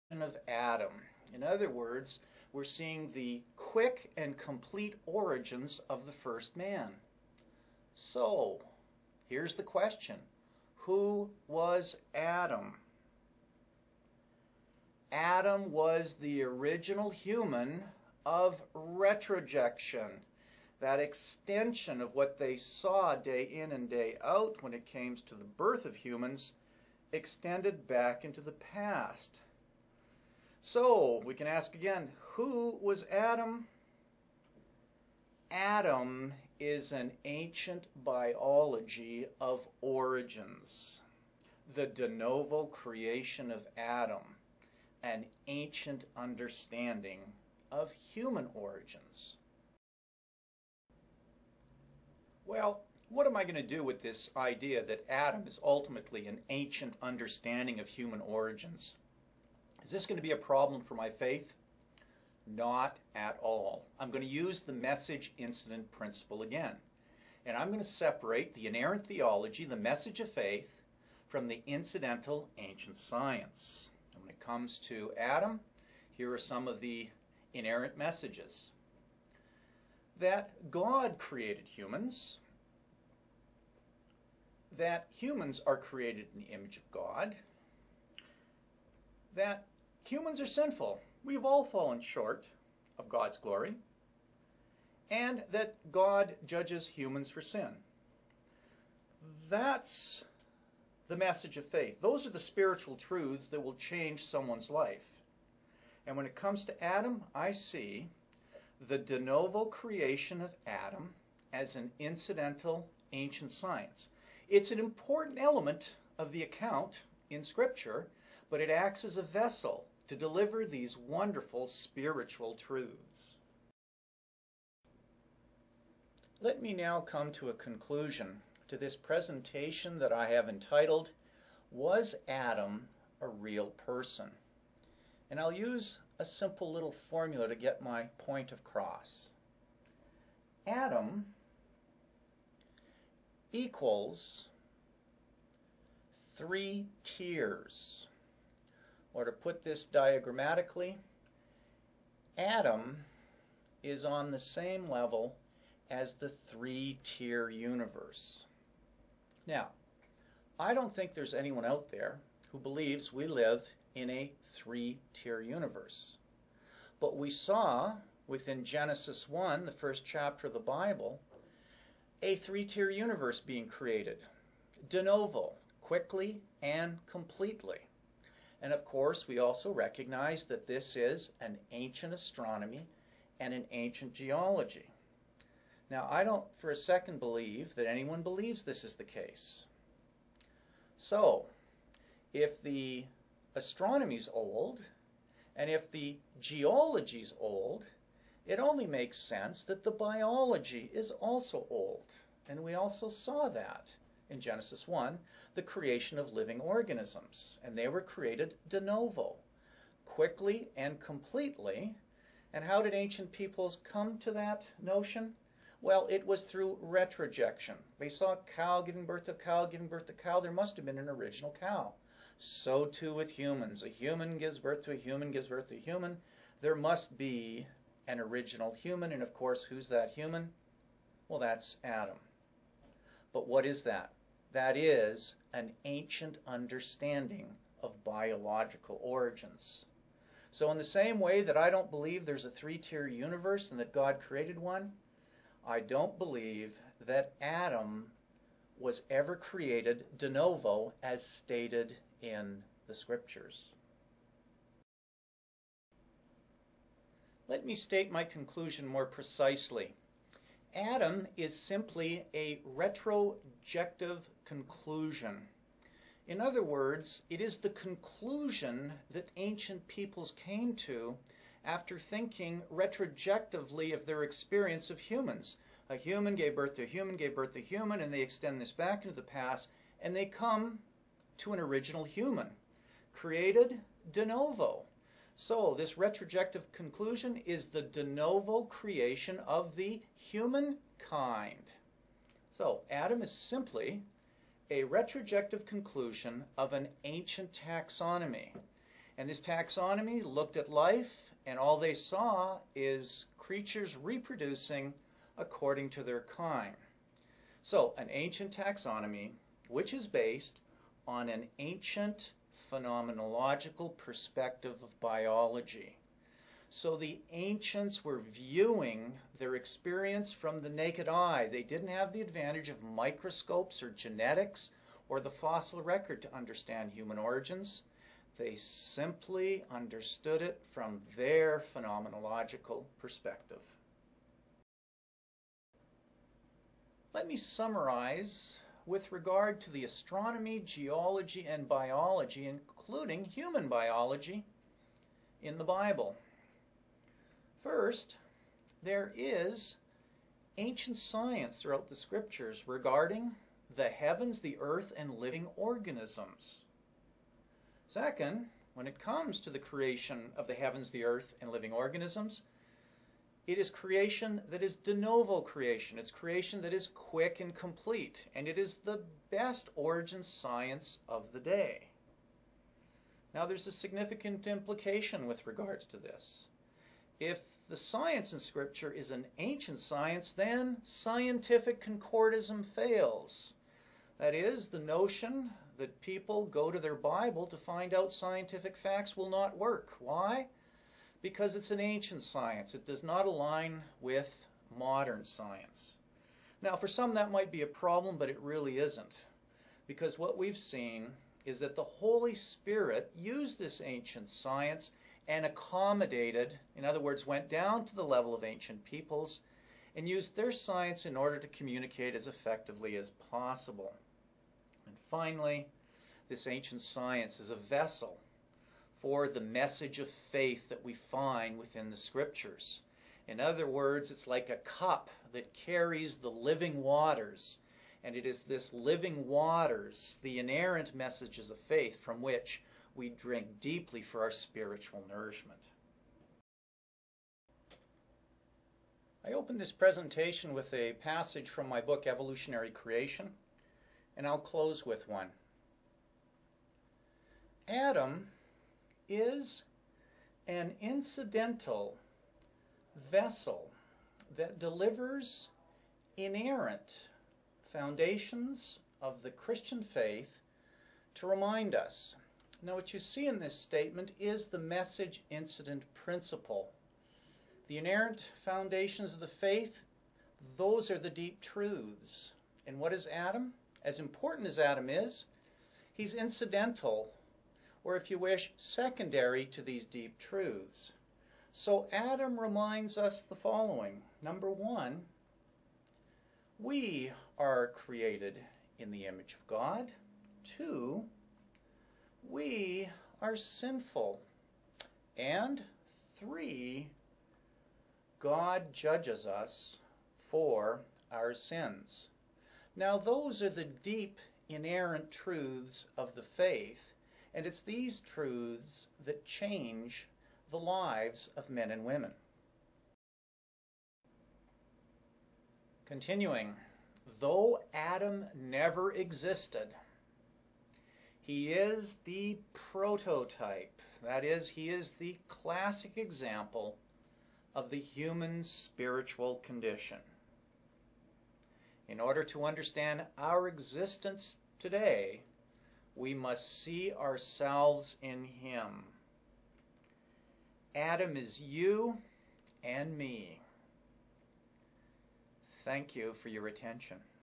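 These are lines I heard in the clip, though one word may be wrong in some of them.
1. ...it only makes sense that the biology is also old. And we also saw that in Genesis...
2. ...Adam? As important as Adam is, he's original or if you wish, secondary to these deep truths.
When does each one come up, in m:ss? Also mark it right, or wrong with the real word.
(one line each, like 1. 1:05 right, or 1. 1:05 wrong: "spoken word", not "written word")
1. 3:18 right
2. 7:53 wrong: "incidental", not "original".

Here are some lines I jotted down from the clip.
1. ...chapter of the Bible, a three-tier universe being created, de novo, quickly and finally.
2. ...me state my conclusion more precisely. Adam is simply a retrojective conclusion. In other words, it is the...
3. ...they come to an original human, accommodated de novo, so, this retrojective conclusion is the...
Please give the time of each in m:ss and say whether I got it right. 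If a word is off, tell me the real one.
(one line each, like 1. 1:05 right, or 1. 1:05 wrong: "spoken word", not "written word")
1. 2:50 wrong: "completely", not "finally"
2. 4:17 right
3. 4:40 wrong: "created", not "accommodated".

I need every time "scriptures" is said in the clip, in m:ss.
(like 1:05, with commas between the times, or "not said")
1:57, 4:12, 5:51, 6:18, 7:01.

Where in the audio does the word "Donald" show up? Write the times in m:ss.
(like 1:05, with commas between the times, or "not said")
not said.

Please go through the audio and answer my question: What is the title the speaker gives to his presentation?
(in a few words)
Was Adam a Real Person?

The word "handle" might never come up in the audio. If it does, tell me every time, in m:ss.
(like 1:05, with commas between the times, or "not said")
not said.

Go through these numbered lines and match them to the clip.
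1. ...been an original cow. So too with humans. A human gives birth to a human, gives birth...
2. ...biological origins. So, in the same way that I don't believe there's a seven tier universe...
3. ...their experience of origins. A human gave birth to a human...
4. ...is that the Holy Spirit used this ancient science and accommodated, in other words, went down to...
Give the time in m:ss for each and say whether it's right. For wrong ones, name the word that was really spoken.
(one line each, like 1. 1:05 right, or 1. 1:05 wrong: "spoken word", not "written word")
1. 3:40 right
2. 3:58 wrong: "three", not "seven"
3. 4:34 wrong: "humans", not "origins"
4. 6:41 right.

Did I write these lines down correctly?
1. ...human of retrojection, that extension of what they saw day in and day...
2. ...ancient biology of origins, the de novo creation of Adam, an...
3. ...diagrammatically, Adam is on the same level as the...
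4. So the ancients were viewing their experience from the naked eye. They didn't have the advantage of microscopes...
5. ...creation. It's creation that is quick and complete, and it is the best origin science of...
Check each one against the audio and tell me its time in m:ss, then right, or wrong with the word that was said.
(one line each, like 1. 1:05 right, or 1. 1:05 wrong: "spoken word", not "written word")
1. 0:17 right
2. 0:37 right
3. 2:29 right
4. 5:16 right
5. 6:05 right.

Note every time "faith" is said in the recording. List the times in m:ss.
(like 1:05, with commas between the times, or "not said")
1:01, 1:10, 1:41, 7:00, 7:11, 7:39, 7:49, 8:26.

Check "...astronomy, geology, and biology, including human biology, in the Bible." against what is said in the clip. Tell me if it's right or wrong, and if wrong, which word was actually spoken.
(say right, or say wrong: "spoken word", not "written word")
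right.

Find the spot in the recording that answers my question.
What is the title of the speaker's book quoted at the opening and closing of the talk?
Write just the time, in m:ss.
7:22.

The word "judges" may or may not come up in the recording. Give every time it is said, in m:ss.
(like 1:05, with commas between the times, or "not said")
1:36, 8:18.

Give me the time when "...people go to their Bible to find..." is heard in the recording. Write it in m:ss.
6:26.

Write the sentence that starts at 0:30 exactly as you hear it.
So we can ask again, who was Adam?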